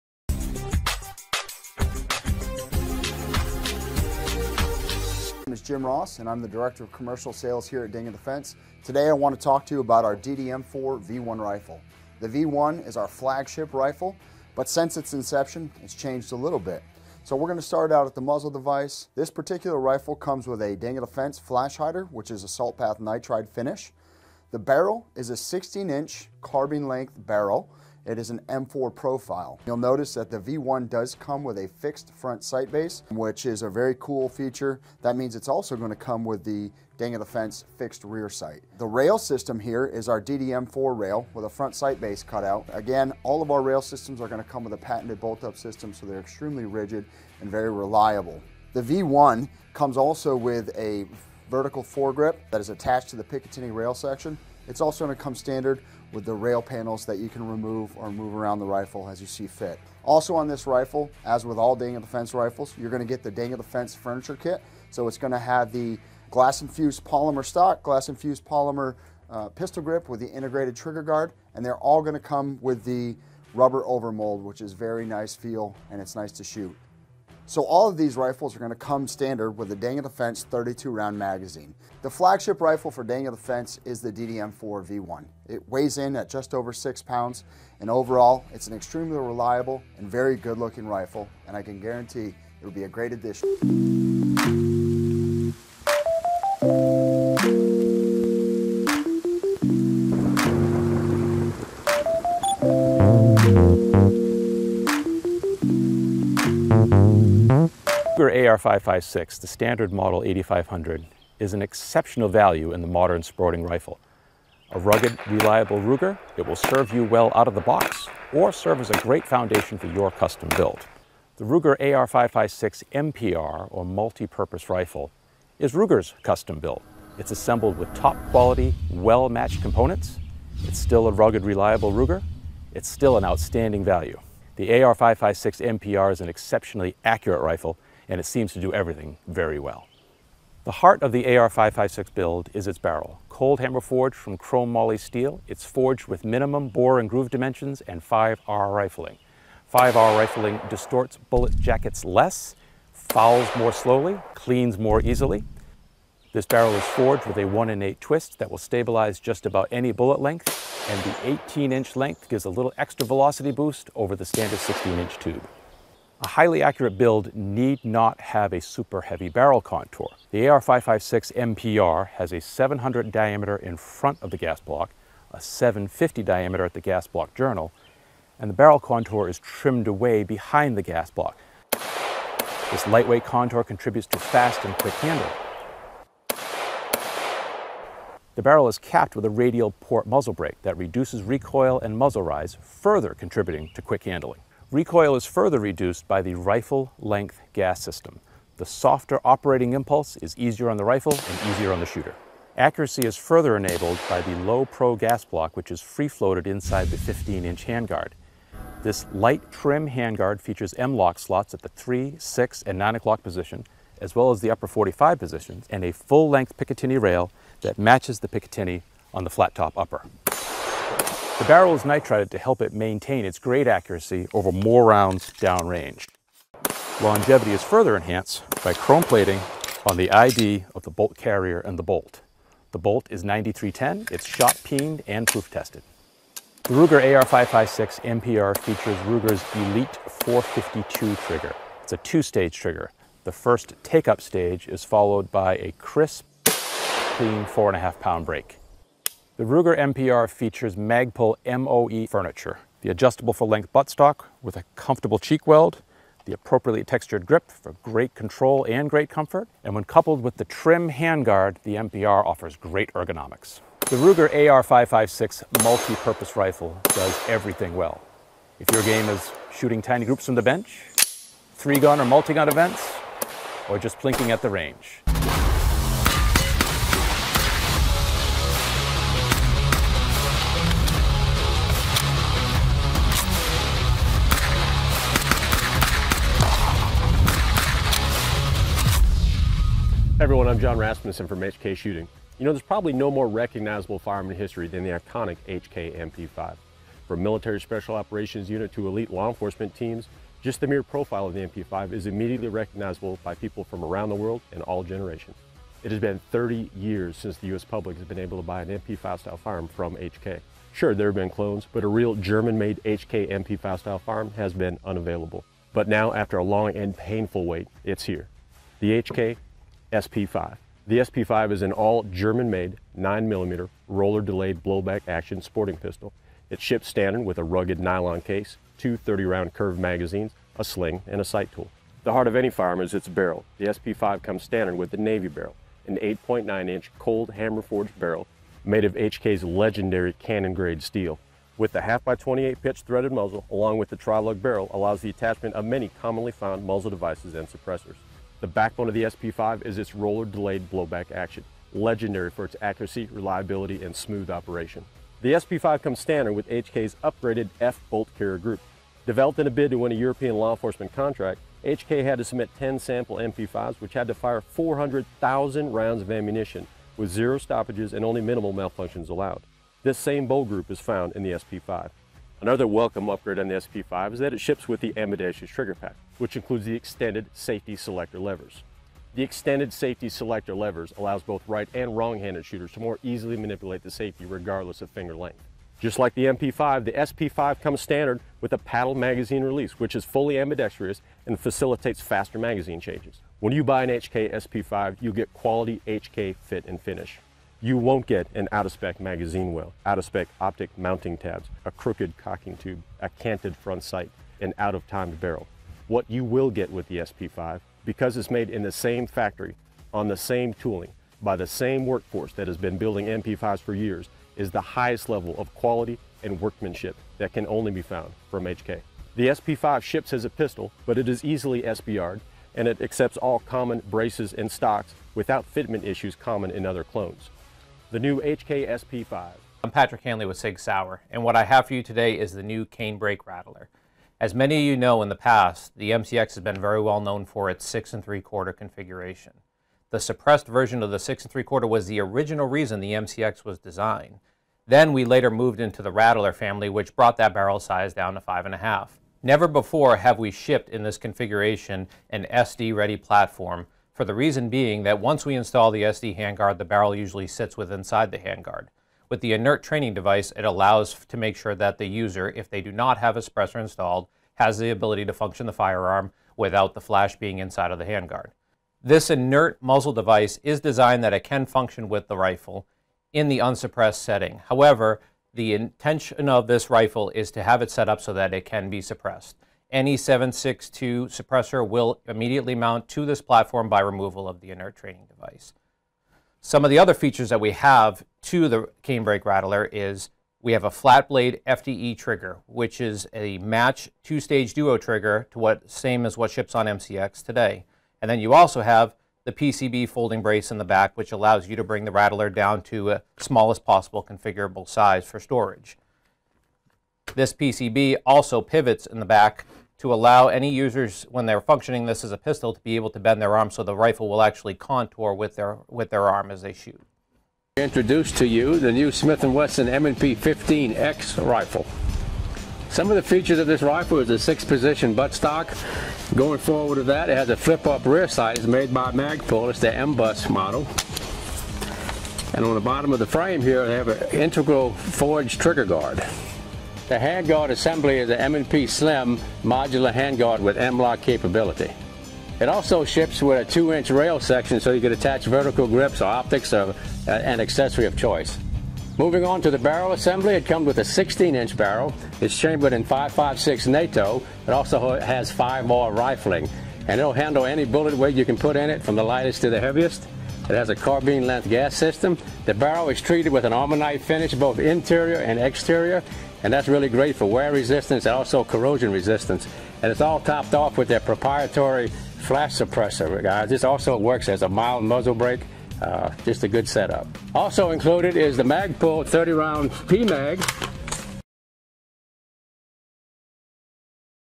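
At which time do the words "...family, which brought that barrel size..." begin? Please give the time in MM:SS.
07:26.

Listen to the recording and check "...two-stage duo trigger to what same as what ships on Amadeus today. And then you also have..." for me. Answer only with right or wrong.
wrong.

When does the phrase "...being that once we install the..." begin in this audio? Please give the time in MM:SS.
07:34.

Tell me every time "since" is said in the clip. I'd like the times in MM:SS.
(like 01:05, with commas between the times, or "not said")
00:14, 05:07.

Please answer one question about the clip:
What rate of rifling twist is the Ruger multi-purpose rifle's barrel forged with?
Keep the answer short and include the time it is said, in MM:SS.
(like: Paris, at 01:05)
1 in 8, at 02:37.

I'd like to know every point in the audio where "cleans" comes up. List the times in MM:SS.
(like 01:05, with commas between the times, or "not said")
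02:34, 04:06.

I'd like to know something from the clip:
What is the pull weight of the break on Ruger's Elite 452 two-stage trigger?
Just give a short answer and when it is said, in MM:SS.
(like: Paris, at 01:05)
4.5 pounds, at 04:07.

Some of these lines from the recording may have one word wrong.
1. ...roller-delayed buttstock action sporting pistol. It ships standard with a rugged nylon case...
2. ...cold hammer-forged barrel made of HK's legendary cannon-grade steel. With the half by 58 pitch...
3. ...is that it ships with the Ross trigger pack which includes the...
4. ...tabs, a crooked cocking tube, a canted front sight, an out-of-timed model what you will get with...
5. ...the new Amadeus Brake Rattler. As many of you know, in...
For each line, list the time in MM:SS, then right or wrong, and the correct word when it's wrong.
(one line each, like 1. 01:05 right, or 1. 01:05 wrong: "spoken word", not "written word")
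1. 05:23 wrong: "blowback", not "buttstock"
2. 05:36 wrong: "28", not "58"
3. 06:14 wrong: "Amadeus", not "Ross"
4. 06:41 wrong: "barrel", not "model"
5. 07:12 wrong: "Cane", not "Amadeus".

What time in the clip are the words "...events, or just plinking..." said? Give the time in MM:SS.
04:32.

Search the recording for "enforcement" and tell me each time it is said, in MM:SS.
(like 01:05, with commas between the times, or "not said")
04:59, 06:00.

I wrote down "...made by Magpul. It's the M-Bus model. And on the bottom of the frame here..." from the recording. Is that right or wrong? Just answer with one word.
right.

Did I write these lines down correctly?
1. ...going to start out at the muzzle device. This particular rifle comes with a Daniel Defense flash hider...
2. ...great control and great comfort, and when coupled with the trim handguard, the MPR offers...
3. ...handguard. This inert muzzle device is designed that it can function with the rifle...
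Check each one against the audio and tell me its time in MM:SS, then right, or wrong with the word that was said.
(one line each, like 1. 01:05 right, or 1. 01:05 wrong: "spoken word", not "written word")
1. 00:17 right
2. 04:17 right
3. 07:47 right.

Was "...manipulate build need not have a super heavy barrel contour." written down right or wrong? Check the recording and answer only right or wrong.
wrong.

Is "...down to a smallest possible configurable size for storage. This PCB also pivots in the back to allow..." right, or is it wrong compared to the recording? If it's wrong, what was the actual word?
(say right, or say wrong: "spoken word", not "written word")
right.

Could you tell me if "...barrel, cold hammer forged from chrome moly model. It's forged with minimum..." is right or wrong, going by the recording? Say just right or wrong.
wrong.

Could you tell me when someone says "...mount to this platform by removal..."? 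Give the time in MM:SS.
08:02.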